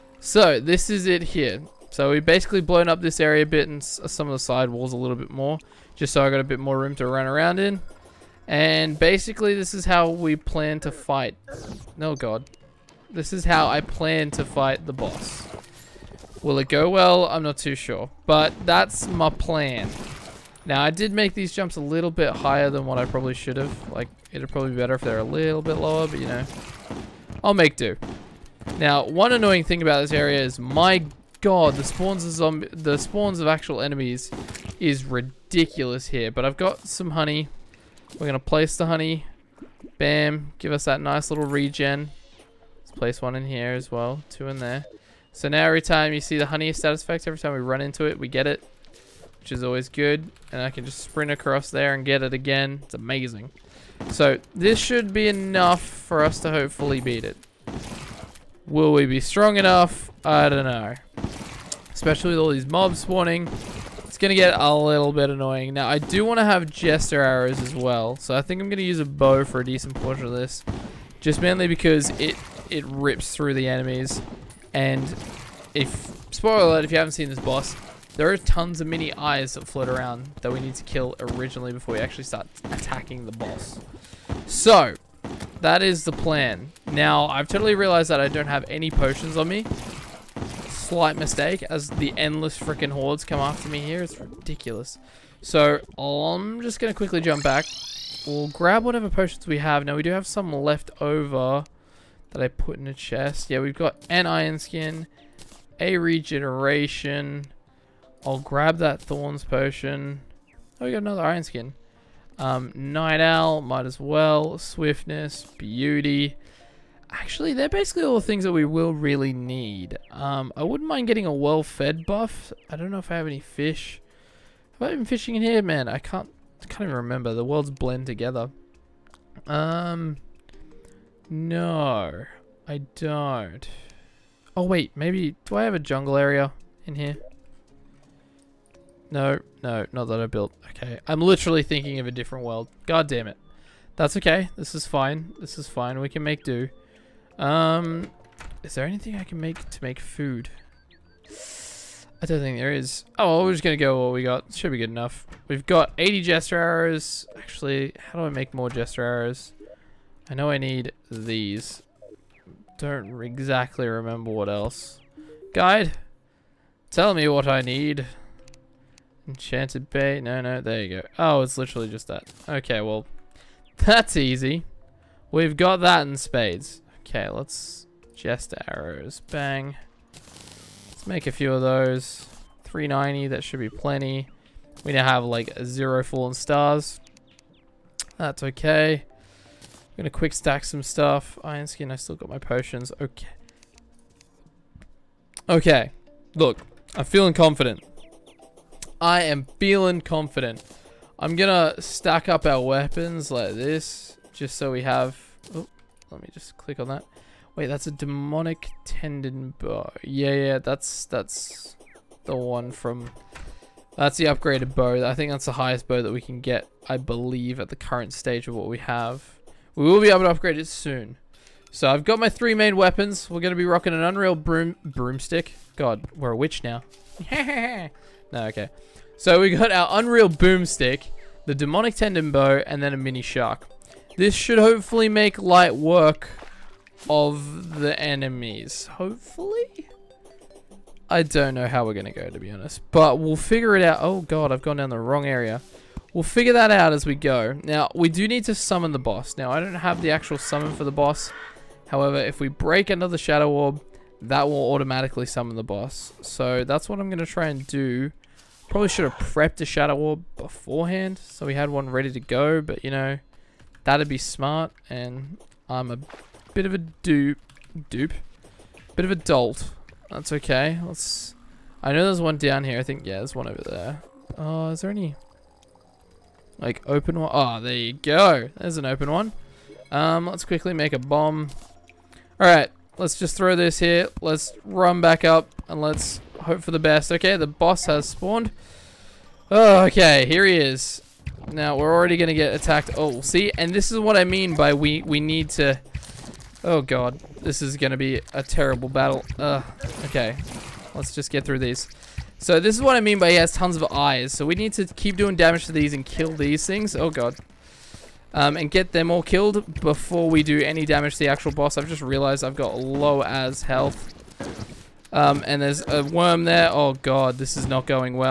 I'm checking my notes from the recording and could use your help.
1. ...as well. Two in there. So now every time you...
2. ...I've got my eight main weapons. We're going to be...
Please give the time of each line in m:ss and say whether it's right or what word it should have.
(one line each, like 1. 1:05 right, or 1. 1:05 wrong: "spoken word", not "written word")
1. 0:43 right
2. 3:41 wrong: "three", not "eight".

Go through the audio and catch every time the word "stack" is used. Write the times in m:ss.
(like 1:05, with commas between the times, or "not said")
3:10, 3:21.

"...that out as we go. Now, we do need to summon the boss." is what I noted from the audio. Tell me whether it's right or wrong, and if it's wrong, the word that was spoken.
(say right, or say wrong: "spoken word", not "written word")
right.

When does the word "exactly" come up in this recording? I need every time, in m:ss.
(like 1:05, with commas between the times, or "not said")
2:43.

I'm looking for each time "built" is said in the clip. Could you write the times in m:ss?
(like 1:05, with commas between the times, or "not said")
2:20.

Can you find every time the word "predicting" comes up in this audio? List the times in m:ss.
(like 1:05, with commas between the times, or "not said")
not said.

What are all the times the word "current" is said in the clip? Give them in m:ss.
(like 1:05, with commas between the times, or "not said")
3:37.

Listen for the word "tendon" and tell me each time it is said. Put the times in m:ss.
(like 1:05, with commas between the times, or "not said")
3:28, 3:51.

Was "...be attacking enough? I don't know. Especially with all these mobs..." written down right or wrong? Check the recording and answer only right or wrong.
wrong.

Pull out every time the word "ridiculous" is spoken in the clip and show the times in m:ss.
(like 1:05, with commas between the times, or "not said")
0:35, 1:34.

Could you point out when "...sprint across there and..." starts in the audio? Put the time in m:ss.
0:51.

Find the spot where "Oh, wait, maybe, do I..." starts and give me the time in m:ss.
2:14.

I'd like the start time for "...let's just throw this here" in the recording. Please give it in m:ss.
4:42.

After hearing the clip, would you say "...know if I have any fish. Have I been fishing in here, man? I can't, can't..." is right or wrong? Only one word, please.
right.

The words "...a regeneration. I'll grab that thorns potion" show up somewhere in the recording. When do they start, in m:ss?
1:45.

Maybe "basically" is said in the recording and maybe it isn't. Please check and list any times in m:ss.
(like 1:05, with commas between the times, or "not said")
0:02, 0:08, 1:57.